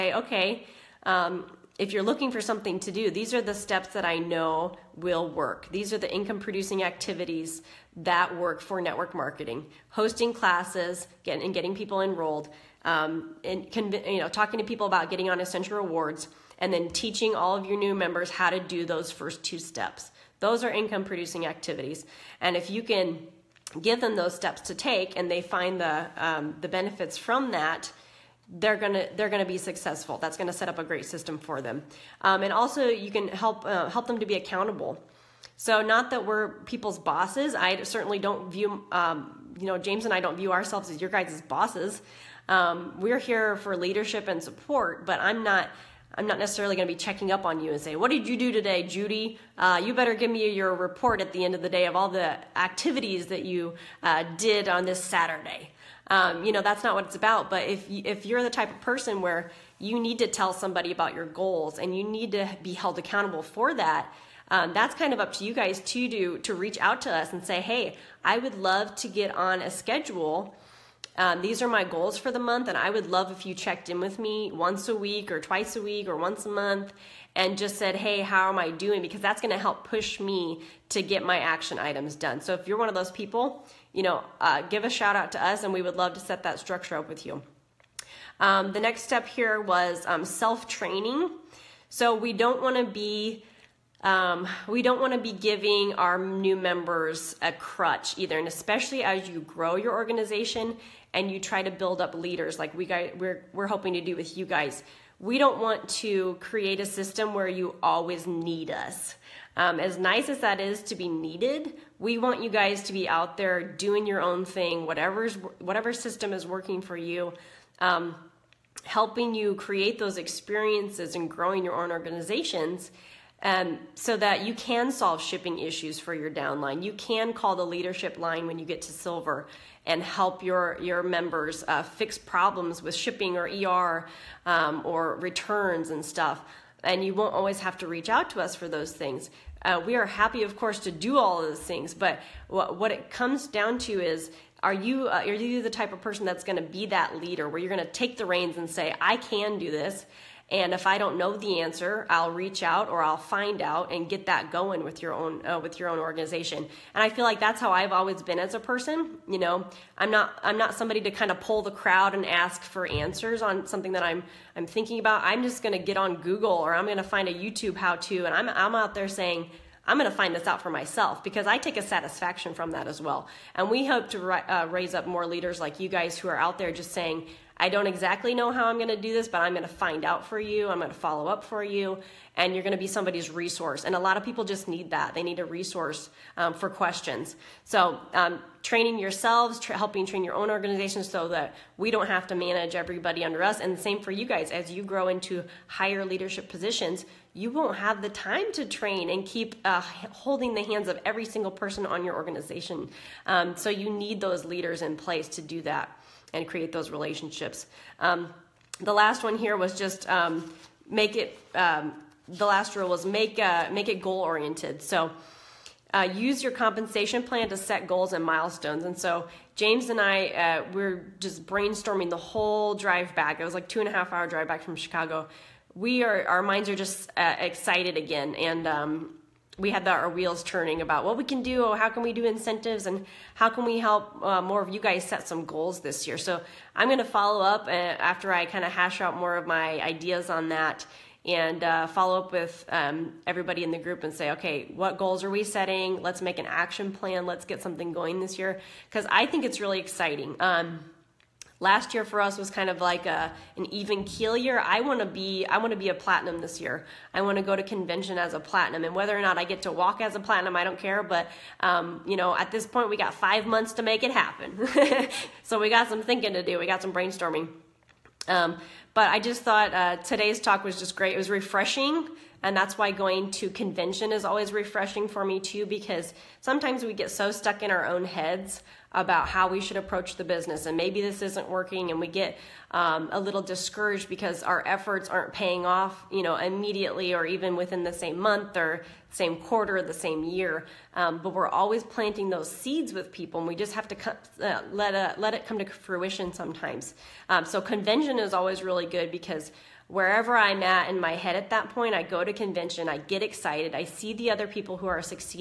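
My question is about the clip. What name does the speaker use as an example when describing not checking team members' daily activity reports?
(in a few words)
Judy.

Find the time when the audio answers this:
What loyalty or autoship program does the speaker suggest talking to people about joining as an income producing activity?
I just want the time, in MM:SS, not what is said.
00:15.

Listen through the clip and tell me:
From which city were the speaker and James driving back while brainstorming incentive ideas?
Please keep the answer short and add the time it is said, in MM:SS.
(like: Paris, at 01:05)
Chicago, at 03:44.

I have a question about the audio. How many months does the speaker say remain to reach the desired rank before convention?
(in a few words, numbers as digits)
5.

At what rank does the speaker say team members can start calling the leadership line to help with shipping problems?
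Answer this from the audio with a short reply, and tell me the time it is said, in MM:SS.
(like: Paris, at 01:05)
Silver, at 02:08.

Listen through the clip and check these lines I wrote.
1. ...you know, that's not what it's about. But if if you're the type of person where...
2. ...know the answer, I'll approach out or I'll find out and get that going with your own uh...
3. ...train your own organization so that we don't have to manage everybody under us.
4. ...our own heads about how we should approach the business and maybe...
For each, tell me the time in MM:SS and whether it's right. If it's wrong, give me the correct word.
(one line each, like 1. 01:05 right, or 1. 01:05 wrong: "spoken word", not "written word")
1. 00:56 right
2. 02:31 wrong: "reach", not "approach"
3. 03:10 right
4. 04:37 right.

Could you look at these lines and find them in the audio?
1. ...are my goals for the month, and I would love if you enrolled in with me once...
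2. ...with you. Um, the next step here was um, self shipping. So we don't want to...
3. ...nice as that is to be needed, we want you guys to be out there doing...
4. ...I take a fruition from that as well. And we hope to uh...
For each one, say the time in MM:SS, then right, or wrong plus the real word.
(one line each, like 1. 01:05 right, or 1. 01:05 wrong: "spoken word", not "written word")
1. 01:11 wrong: "checked", not "enrolled"
2. 01:27 wrong: "training", not "shipping"
3. 01:49 right
4. 02:51 wrong: "satisfaction", not "fruition".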